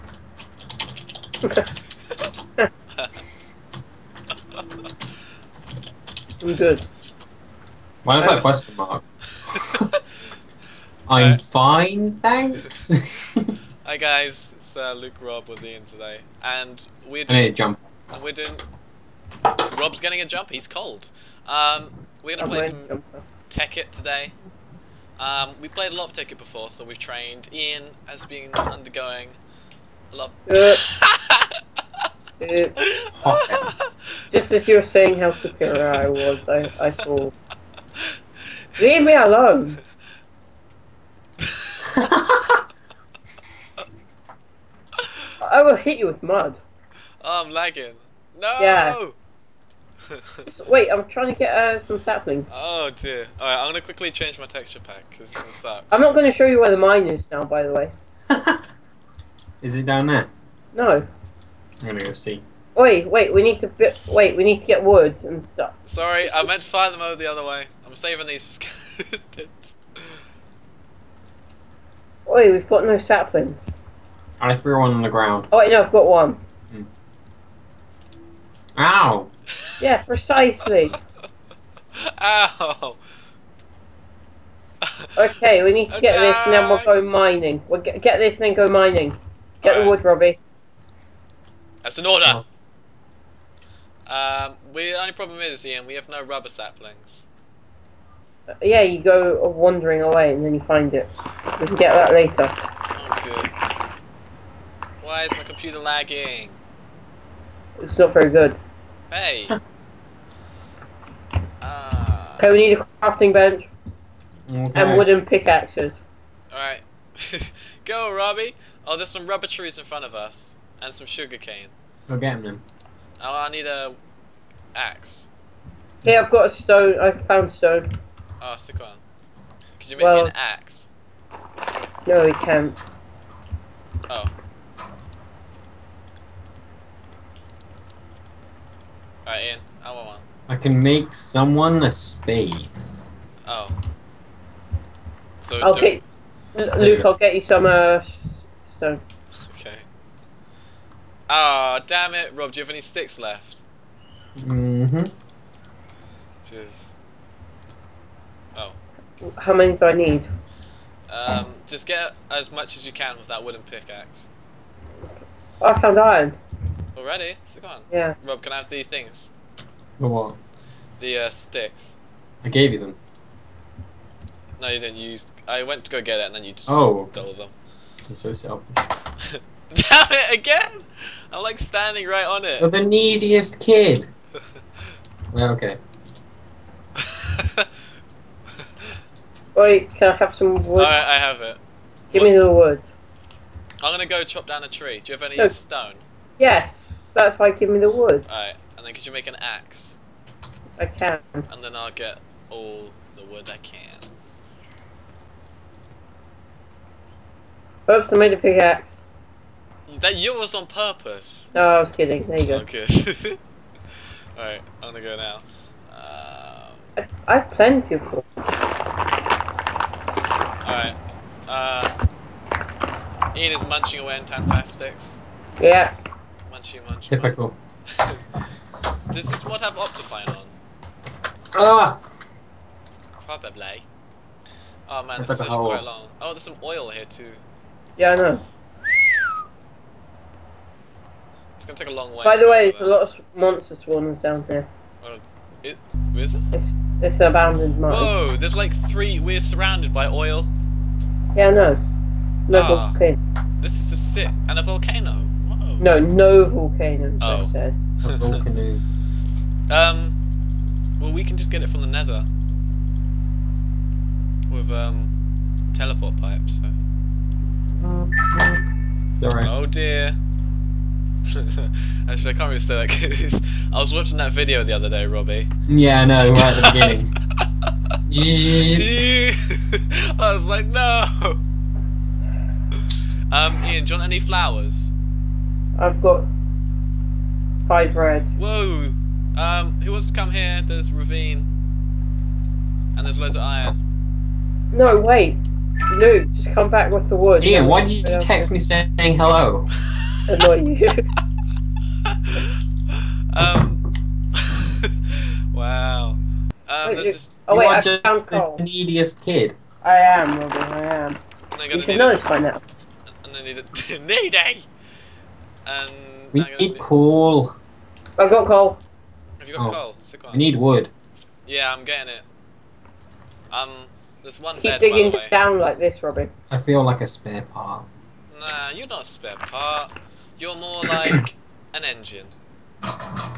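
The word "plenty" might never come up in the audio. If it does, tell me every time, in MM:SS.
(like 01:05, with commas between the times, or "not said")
03:37.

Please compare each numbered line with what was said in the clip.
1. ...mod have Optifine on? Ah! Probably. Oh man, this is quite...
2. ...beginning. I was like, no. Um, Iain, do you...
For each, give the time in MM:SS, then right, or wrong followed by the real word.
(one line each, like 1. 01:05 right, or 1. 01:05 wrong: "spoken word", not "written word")
1. 03:49 right
2. 04:38 right.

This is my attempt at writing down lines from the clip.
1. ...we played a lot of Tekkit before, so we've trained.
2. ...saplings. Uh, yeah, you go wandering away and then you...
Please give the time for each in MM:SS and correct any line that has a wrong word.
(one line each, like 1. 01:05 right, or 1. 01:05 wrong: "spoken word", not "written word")
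1. 00:25 right
2. 01:36 right.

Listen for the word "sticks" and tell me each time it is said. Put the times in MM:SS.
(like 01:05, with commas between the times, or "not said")
02:08, 02:32, 02:51, 03:44, 05:19.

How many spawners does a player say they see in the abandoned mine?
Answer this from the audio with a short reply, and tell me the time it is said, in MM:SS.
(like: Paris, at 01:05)
3, at 04:08.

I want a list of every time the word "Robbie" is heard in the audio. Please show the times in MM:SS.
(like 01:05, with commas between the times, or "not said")
01:30, 01:58, 04:35.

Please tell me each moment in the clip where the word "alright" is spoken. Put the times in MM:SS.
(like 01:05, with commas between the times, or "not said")
00:53, 02:19, 03:18, 03:34, 03:40, 04:29.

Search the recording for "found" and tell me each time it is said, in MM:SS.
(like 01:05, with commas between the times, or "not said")
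02:07, 02:45.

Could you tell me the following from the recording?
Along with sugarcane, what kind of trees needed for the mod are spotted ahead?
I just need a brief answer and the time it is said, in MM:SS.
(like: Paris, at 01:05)
rubber trees, at 01:59.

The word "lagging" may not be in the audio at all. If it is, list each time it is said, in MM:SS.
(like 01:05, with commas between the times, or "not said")
00:47, 01:45.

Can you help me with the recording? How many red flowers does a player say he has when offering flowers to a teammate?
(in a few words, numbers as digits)
5.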